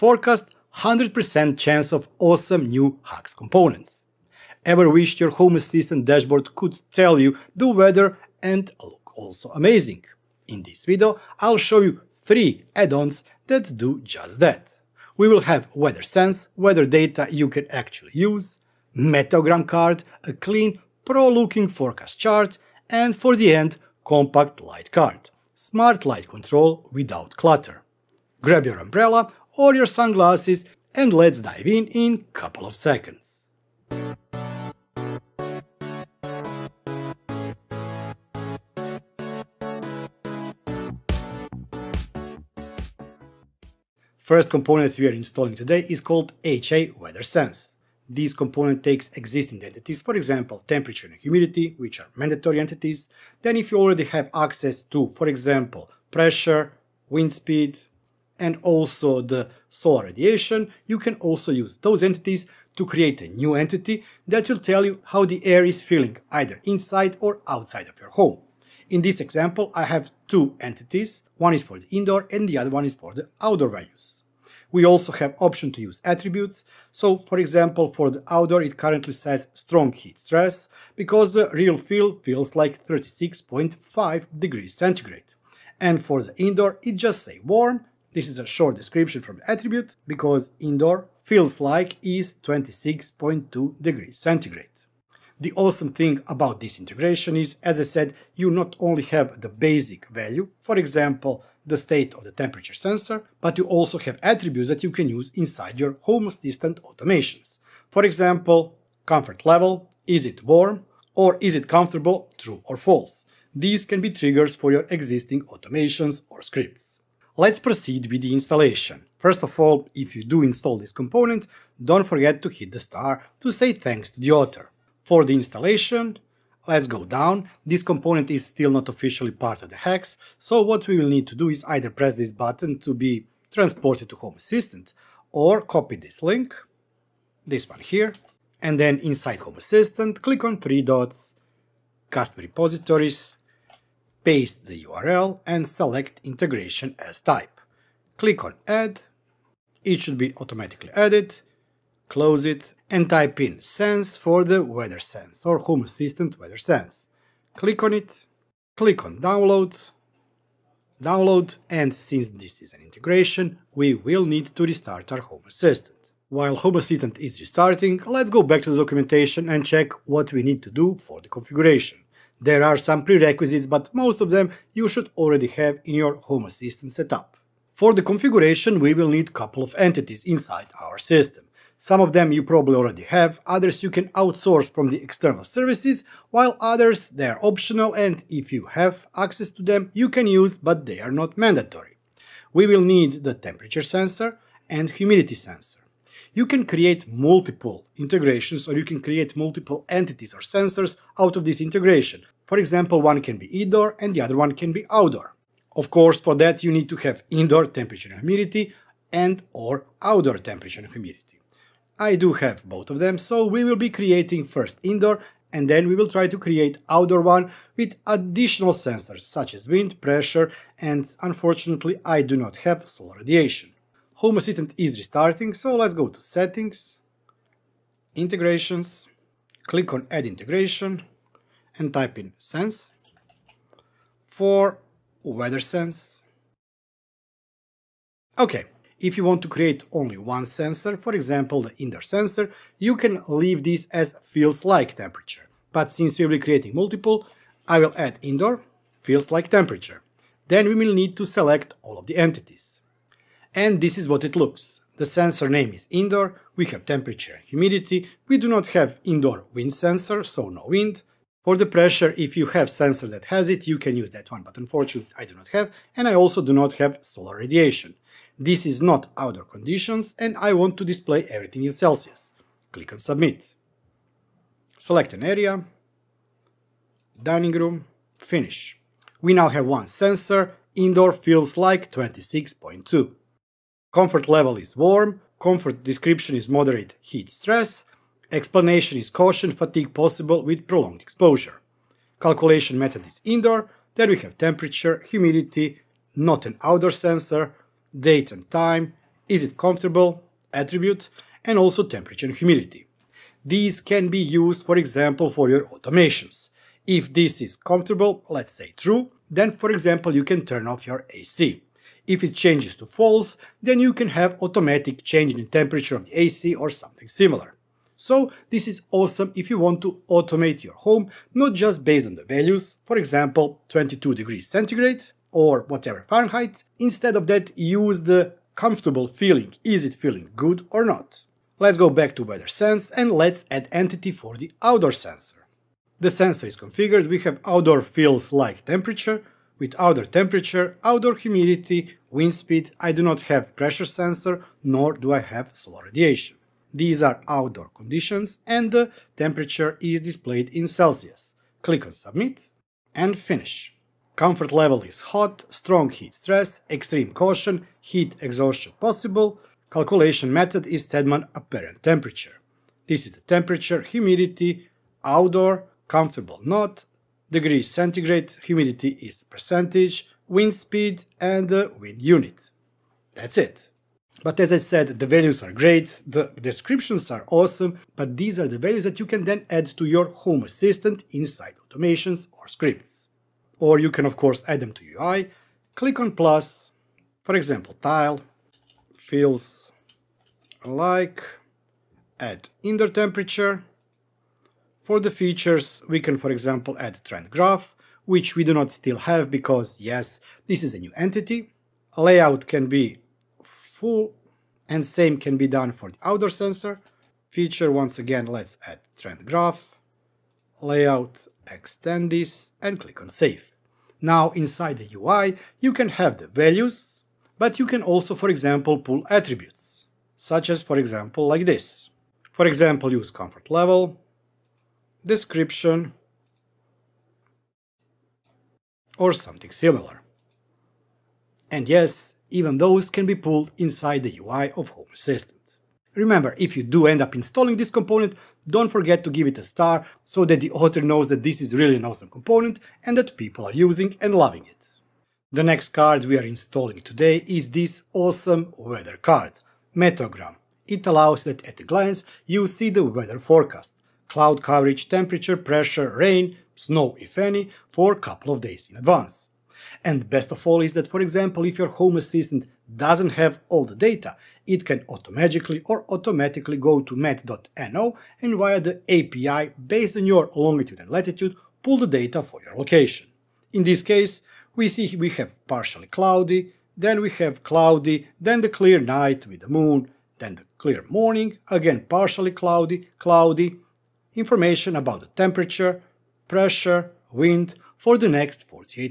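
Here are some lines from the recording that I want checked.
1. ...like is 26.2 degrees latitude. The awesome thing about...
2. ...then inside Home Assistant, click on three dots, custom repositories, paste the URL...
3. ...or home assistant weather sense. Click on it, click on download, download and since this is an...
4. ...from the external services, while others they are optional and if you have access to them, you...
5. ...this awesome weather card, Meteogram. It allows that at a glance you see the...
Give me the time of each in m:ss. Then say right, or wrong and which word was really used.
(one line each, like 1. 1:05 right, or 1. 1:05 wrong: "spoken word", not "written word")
1. 1:31 wrong: "centigrade", not "latitude"
2. 2:18 right
3. 2:35 right
4. 3:04 right
5. 7:27 right.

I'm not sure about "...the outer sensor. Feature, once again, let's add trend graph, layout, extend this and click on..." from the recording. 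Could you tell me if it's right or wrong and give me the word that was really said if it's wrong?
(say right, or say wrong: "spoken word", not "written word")
right.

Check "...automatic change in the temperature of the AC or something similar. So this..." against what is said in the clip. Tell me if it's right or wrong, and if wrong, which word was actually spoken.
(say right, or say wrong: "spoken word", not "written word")
right.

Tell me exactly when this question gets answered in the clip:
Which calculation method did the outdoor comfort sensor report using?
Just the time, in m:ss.
6:00.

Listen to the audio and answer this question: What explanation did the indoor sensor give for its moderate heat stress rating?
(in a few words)
caution fatigue possible.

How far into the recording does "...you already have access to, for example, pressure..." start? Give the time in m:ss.
0:53.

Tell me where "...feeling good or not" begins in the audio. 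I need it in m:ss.
5:29.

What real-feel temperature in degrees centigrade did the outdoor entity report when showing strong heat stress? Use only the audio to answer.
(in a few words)
36.5.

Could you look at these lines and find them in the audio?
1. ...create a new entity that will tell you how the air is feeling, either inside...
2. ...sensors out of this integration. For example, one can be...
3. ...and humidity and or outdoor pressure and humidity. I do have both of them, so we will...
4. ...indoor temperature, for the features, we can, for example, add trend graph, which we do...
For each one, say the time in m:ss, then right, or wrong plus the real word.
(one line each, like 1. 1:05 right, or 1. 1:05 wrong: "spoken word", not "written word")
1. 1:02 right
2. 3:20 right
3. 3:28 wrong: "temperature", not "pressure"
4. 6:32 right.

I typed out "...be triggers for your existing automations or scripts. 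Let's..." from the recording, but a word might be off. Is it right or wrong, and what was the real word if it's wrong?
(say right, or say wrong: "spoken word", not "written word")
right.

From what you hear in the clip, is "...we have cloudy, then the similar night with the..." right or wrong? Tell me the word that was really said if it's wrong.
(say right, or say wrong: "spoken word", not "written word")
wrong: "clear", not "similar".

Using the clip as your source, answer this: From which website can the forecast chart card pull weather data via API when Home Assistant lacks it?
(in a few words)
met.no.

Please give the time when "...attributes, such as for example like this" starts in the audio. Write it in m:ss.
6:59.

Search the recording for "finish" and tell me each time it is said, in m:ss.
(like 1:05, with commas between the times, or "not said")
4:38, 5:53.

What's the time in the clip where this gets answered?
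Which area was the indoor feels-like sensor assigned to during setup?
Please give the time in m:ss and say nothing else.
4:37.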